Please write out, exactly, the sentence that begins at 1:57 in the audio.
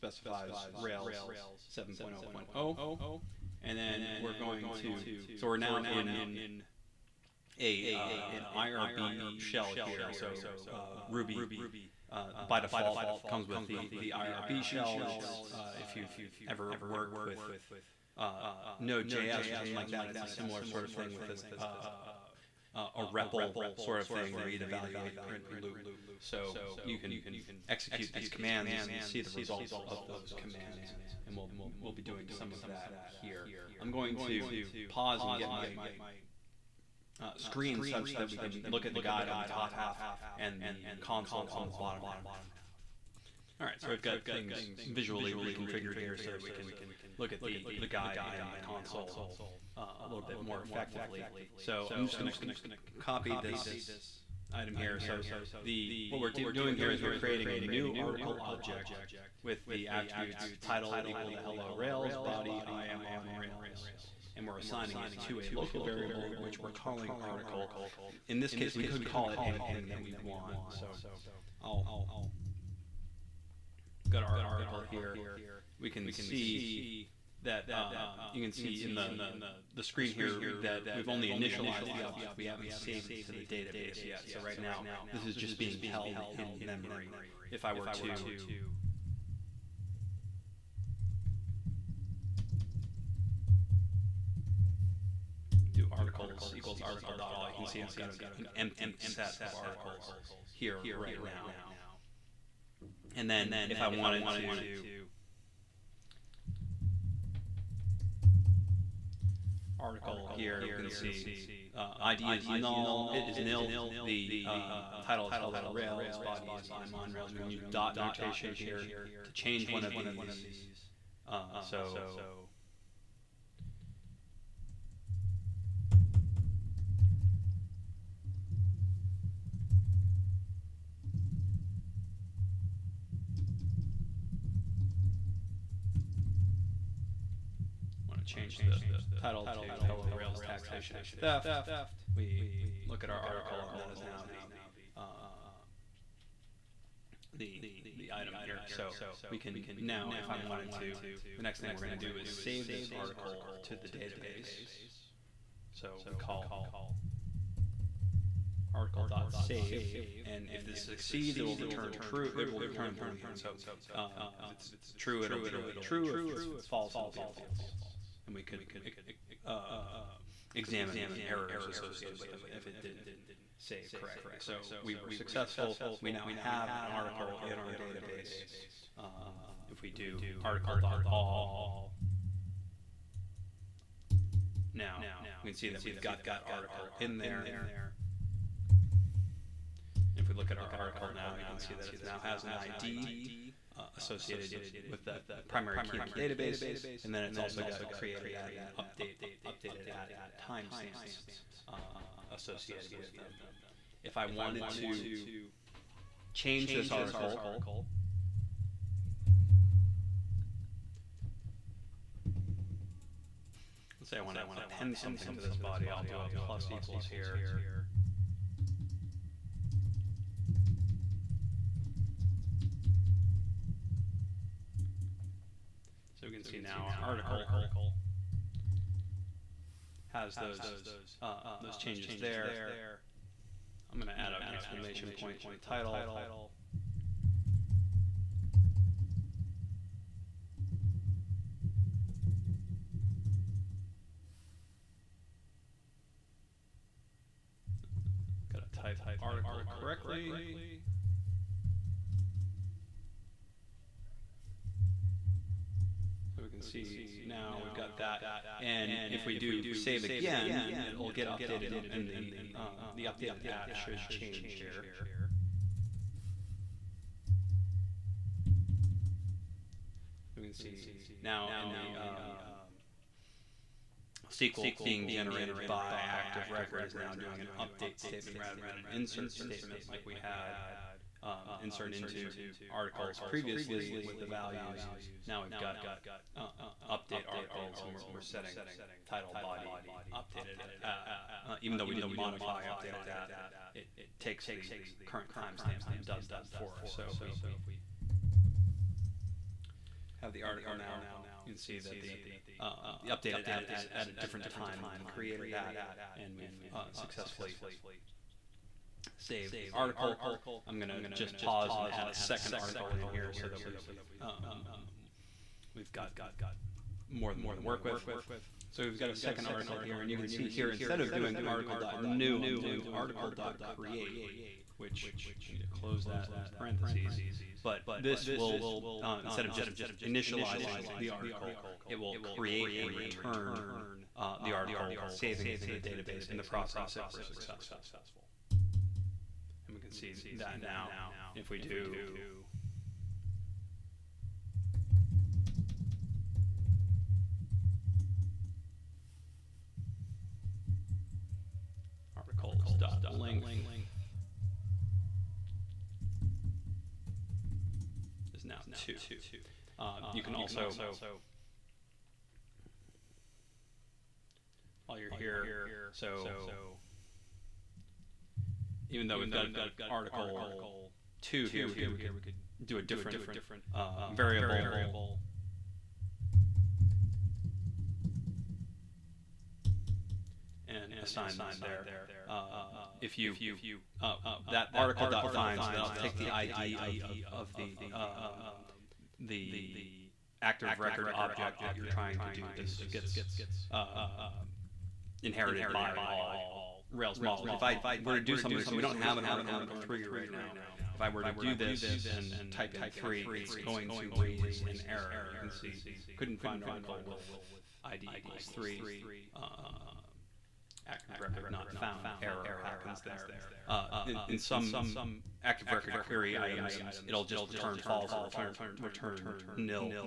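We can use dot notation here to change one of these.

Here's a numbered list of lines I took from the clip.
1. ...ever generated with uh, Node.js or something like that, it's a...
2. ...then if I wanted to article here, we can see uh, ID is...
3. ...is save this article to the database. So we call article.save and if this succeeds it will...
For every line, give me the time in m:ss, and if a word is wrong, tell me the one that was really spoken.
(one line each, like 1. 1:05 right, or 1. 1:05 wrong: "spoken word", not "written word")
1. 0:16 wrong: "worked", not "generated"
2. 1:43 right
3. 2:32 right.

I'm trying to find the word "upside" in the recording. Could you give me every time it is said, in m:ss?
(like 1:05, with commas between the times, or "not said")
not said.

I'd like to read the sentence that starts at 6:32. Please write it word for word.
This gets um, inherited by all Rails models.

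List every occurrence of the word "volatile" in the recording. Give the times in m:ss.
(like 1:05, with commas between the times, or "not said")
not said.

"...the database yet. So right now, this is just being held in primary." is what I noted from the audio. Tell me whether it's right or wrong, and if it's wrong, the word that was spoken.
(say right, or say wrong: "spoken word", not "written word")
wrong: "memory", not "primary".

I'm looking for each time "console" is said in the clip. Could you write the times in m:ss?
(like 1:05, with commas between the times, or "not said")
0:41, 0:48.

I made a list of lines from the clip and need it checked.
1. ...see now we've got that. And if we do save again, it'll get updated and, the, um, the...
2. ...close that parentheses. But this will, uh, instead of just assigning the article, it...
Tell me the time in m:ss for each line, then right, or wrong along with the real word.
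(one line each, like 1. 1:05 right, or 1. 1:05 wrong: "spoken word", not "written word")
1. 4:16 right
2. 5:25 wrong: "initializing", not "assigning".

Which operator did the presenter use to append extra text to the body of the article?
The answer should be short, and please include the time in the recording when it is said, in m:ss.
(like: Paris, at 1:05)
plus equals, at 3:36.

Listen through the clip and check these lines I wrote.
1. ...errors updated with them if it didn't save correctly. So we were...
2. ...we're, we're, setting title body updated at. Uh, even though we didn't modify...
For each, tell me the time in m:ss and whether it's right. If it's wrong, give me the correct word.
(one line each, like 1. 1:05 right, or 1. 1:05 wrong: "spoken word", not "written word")
1. 2:51 wrong: "associated", not "updated"
2. 4:47 right.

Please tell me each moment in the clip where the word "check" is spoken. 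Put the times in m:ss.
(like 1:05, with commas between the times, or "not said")
not said.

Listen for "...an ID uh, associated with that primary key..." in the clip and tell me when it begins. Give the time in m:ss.
3:12.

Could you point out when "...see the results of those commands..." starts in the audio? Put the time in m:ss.
0:28.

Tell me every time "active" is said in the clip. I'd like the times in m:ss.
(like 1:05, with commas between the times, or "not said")
4:36, 6:30, 6:50, 6:55.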